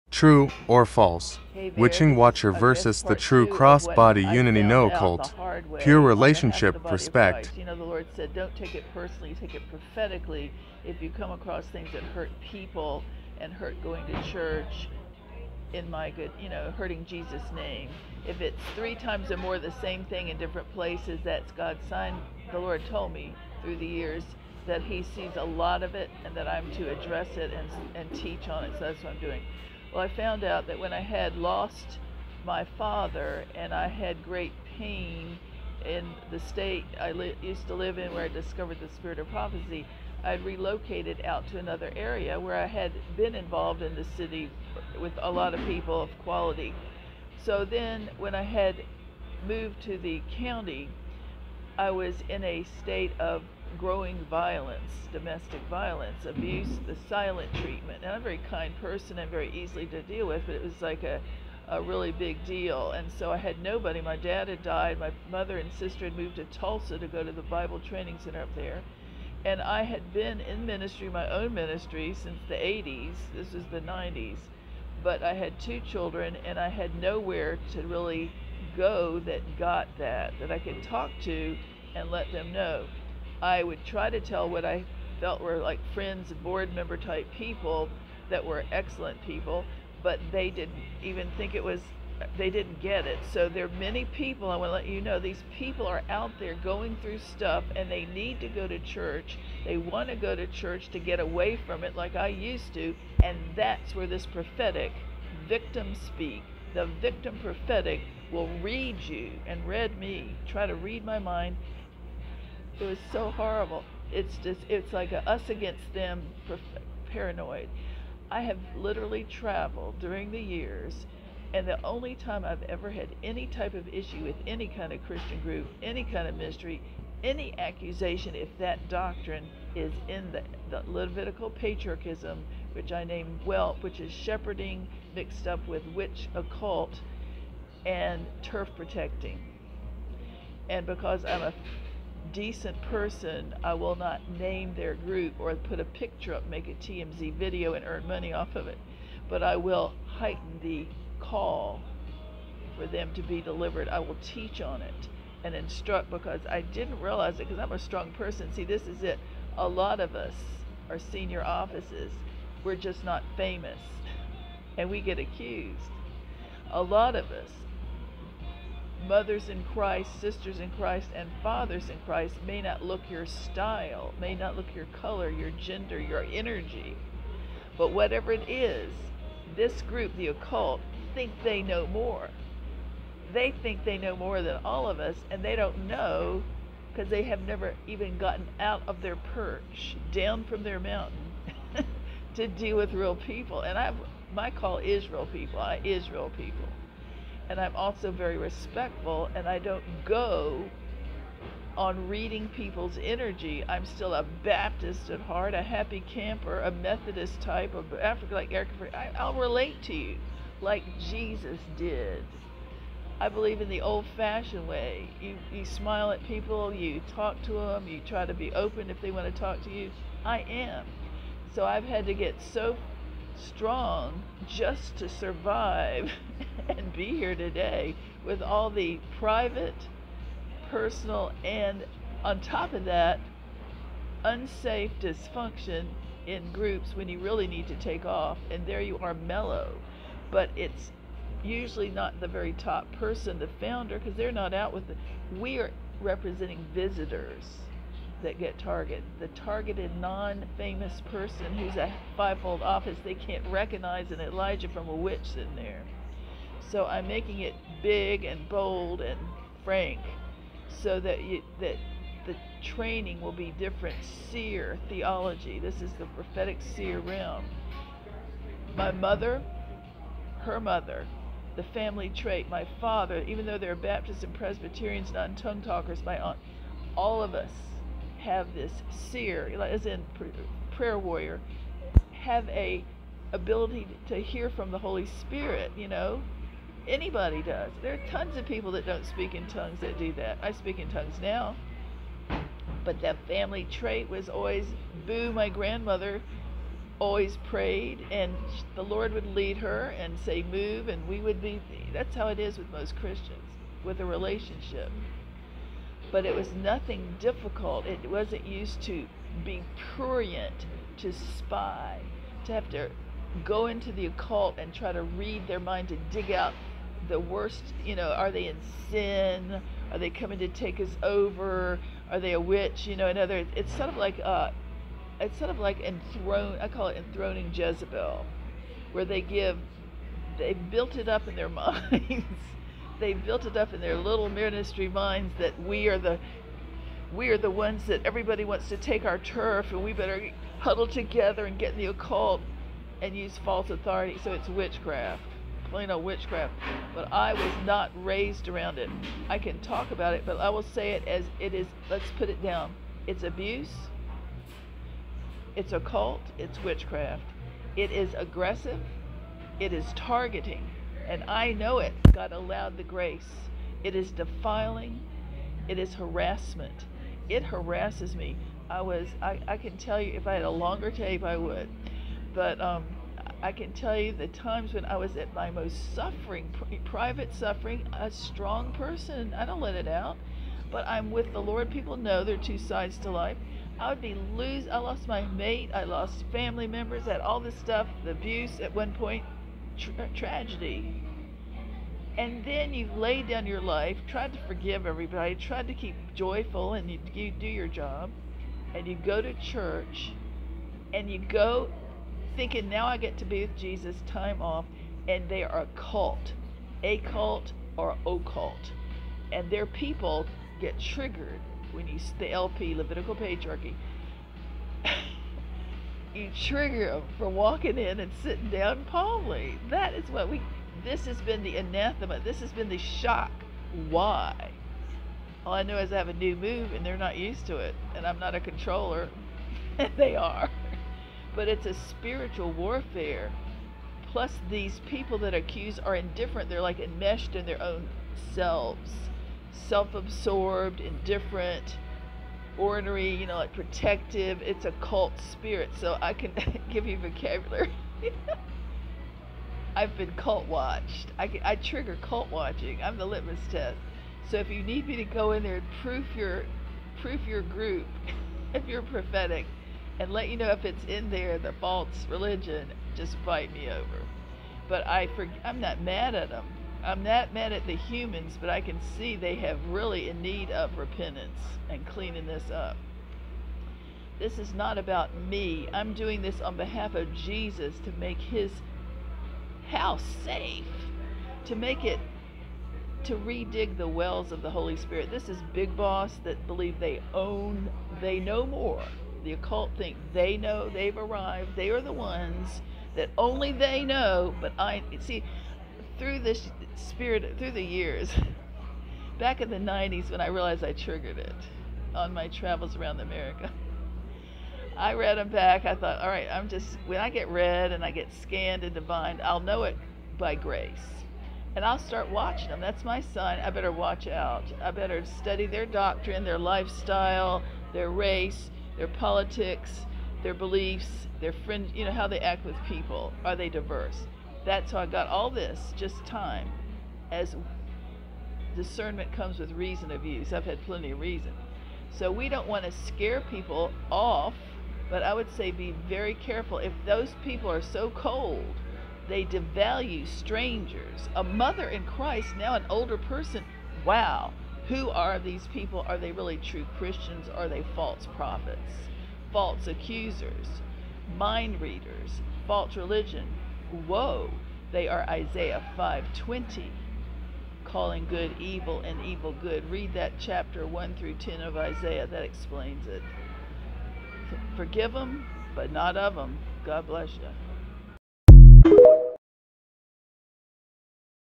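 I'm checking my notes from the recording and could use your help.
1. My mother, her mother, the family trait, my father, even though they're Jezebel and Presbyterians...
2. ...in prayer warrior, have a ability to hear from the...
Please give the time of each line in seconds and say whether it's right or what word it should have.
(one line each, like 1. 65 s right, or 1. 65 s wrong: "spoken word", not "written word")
1. 268 s wrong: "Baptists", not "Jezebel"
2. 279 s right.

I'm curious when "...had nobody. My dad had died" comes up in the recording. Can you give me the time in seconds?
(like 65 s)
63 s.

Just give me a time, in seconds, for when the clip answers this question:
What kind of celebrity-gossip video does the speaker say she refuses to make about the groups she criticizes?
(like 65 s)
146 s.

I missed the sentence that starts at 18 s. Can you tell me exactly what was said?
If it's three times or more the same thing in different places, that's God's sign.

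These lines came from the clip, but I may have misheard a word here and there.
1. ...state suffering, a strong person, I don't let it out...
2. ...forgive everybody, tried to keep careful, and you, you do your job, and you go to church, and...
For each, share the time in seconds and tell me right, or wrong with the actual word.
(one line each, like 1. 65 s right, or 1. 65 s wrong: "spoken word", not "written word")
1. 376 s wrong: "private", not "state"
2. 394 s wrong: "joyful", not "careful".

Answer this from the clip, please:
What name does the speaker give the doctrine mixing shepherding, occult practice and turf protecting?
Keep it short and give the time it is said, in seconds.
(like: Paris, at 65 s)
Levitical patriarchism, at 130 s.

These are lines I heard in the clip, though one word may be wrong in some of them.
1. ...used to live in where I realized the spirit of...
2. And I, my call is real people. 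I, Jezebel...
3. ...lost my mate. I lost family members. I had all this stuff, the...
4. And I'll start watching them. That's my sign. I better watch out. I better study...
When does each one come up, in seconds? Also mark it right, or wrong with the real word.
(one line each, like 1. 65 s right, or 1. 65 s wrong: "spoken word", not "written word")
1. 37 s wrong: "discovered", not "realized"
2. 193 s wrong: "Israel", not "Jezebel"
3. 384 s right
4. 511 s right.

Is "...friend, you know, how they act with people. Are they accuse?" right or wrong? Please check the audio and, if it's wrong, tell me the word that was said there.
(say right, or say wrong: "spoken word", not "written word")
wrong: "diverse", not "accuse".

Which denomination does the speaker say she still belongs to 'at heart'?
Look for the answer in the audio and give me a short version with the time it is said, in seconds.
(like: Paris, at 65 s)
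Baptist, at 204 s.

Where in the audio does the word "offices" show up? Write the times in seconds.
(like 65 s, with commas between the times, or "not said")
161 s, 252 s.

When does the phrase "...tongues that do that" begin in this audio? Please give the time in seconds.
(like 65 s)
289 s.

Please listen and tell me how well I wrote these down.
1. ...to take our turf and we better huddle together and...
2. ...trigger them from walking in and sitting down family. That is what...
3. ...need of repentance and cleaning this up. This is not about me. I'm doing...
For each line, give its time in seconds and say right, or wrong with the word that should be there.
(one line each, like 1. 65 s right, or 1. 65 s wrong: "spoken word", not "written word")
1. 338 s right
2. 416 s wrong: "calmly", not "family"
3. 470 s right.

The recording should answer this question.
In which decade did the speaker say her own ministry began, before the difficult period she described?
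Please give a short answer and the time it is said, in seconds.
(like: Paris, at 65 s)
the 80s, at 72 s.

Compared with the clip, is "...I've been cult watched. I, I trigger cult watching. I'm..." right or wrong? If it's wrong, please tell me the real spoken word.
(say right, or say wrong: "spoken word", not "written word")
right.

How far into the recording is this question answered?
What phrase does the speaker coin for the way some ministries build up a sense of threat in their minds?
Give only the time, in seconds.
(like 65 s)
326 s.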